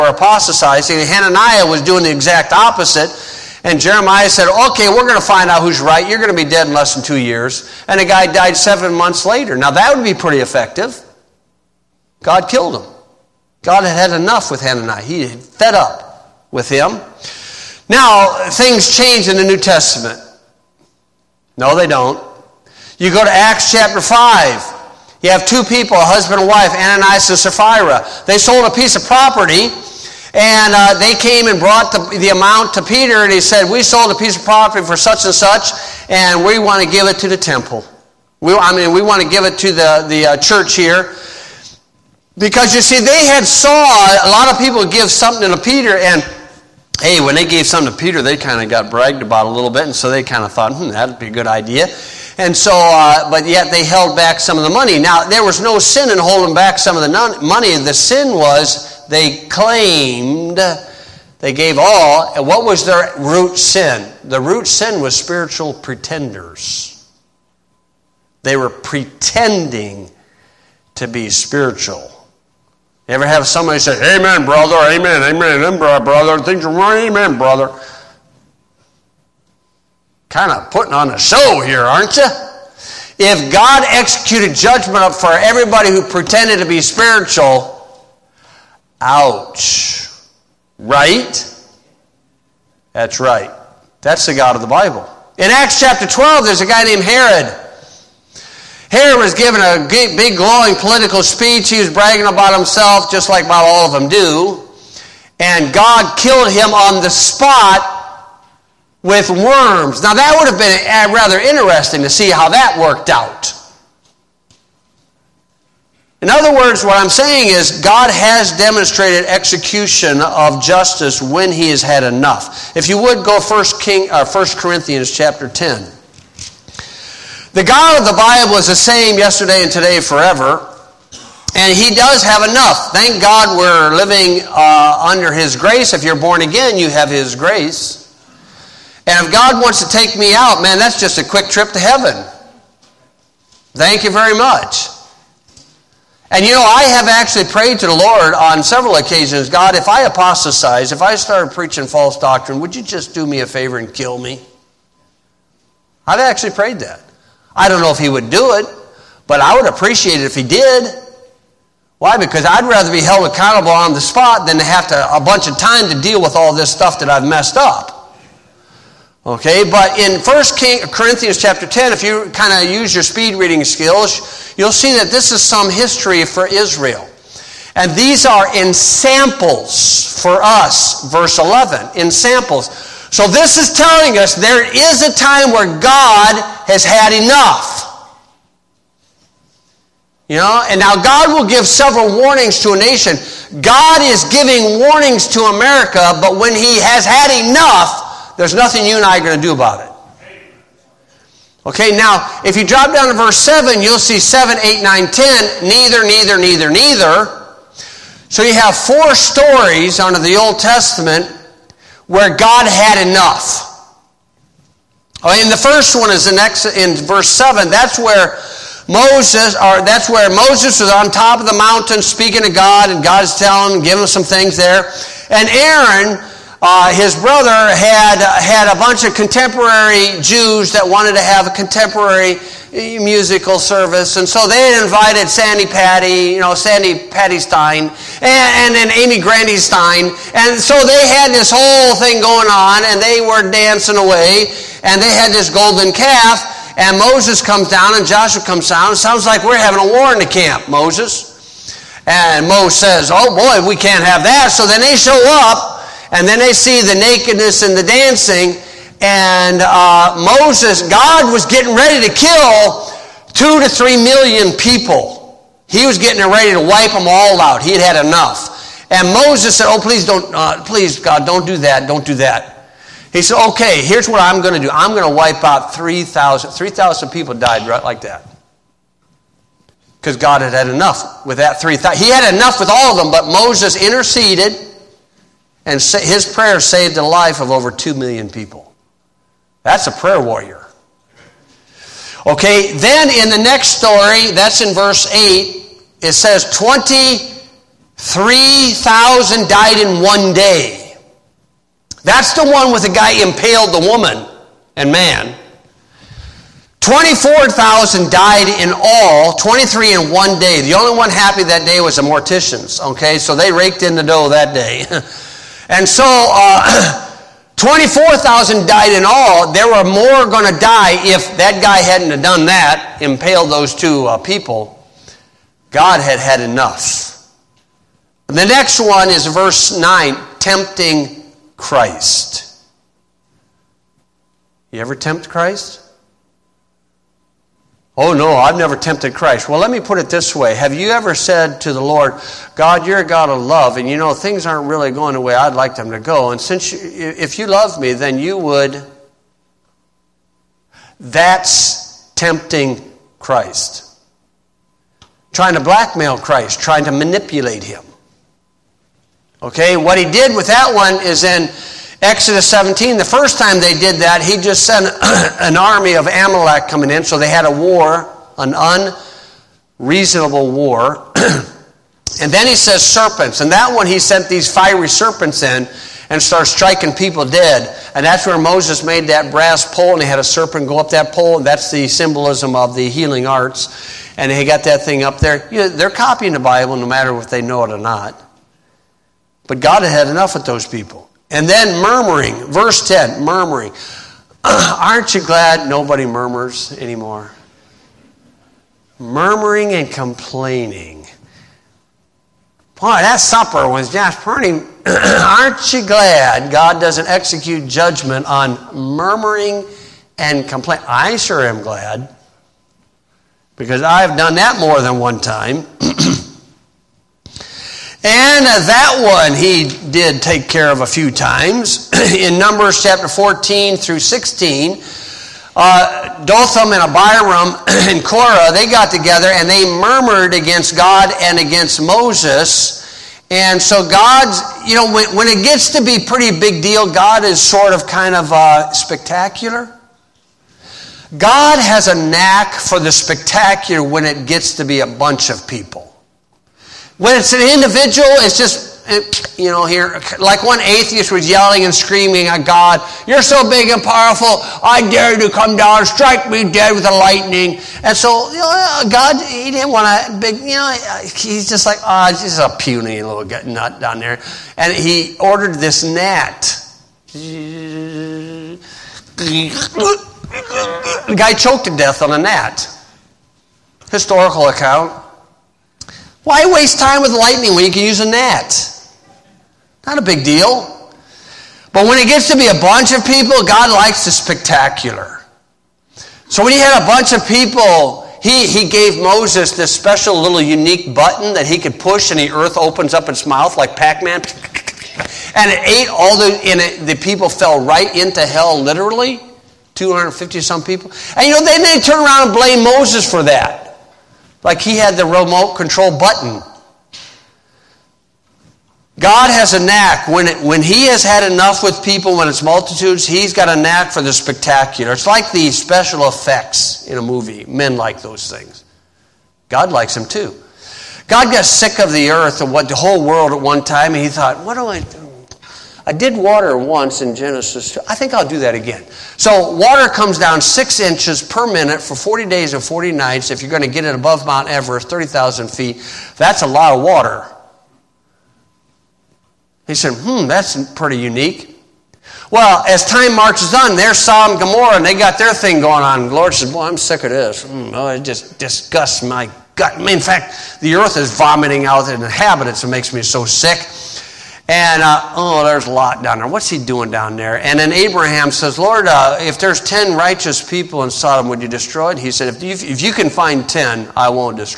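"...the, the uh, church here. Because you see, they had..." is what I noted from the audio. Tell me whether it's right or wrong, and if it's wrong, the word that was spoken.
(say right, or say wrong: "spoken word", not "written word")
right.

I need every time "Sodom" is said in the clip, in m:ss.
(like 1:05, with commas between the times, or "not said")
9:03, 9:20.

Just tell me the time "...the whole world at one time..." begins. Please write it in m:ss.
8:42.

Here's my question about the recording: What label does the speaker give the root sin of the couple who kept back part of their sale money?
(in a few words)
spiritual pretenders.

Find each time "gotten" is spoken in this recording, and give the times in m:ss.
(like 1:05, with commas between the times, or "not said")
not said.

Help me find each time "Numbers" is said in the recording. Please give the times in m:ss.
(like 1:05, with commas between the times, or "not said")
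7:02.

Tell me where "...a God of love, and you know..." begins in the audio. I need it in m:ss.
5:42.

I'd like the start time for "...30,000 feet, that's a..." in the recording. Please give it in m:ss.
8:54.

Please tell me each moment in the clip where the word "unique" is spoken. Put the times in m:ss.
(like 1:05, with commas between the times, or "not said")
8:10, 9:00.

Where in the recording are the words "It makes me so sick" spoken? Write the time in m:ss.
9:12.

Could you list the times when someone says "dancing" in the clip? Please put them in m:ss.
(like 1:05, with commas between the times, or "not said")
4:03, 4:17.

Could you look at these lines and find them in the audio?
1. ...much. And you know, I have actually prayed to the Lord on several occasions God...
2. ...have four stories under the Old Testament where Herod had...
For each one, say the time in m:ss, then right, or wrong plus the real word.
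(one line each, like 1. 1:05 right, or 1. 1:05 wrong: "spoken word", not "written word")
1. 2:24 right
2. 3:28 wrong: "God", not "Herod".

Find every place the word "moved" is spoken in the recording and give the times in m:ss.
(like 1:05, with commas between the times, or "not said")
not said.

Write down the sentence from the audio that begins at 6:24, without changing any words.
And he got that thing up there.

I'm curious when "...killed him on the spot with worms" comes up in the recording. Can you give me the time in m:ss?
1:46.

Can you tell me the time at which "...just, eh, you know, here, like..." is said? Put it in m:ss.
7:28.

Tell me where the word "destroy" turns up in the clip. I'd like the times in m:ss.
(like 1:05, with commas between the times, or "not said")
9:21.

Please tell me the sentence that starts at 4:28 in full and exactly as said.
And Moses said, Oh, please don't, uh, please, God, don't do that.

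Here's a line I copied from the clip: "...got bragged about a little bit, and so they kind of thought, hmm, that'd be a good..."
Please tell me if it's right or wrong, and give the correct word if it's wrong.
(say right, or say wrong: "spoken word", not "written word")
right.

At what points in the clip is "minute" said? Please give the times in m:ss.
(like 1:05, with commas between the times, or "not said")
8:51.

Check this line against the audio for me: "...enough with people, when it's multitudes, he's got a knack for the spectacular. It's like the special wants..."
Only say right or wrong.
wrong.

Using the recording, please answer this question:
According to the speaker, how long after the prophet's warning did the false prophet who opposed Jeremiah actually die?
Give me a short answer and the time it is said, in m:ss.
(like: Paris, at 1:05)
7 months, at 0:08.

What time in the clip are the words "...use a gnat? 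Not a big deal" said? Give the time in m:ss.
7:57.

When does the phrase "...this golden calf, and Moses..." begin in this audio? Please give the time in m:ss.
4:05.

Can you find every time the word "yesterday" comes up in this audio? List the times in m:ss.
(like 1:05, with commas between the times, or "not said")
2:09.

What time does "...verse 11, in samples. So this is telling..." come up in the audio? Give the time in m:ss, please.
3:01.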